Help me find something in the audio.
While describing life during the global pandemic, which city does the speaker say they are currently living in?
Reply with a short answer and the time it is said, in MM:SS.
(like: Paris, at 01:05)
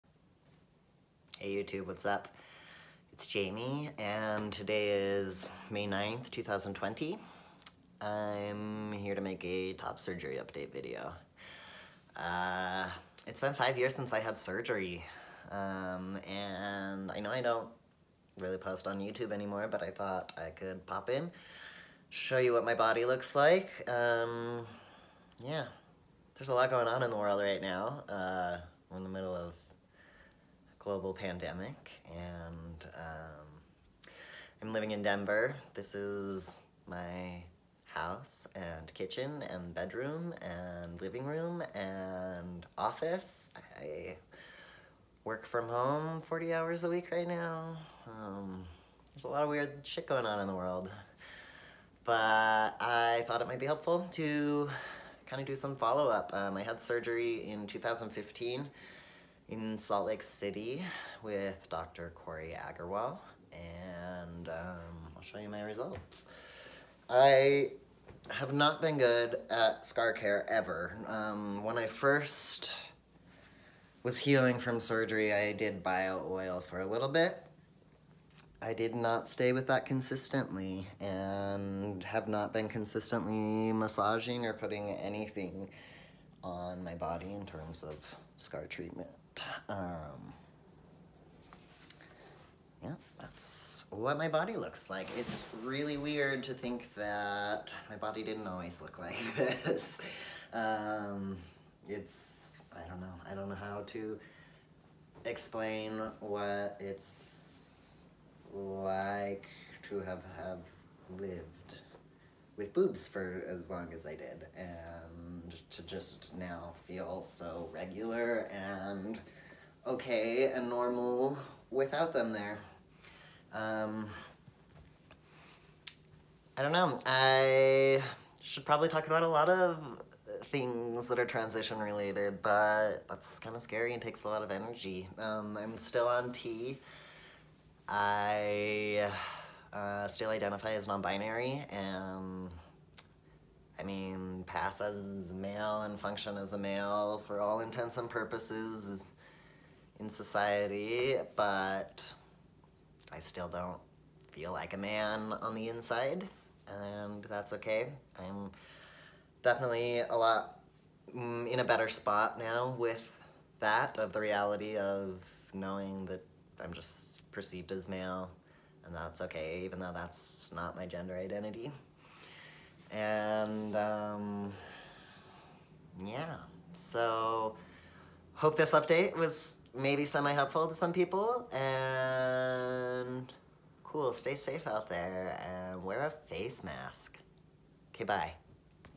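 Denver, at 00:35.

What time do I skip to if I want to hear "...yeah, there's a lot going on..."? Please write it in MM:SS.
00:25.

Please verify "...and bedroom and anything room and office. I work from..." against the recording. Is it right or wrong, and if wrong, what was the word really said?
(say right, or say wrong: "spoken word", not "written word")
wrong: "living", not "anything".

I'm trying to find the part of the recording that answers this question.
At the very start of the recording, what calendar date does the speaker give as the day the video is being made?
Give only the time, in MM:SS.
00:05.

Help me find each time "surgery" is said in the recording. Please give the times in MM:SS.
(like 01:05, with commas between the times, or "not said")
00:09, 00:14, 00:56, 01:14.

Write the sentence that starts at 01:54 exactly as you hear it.
And to just now feel so regular and okay and normal without them there.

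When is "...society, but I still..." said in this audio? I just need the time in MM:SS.
02:30.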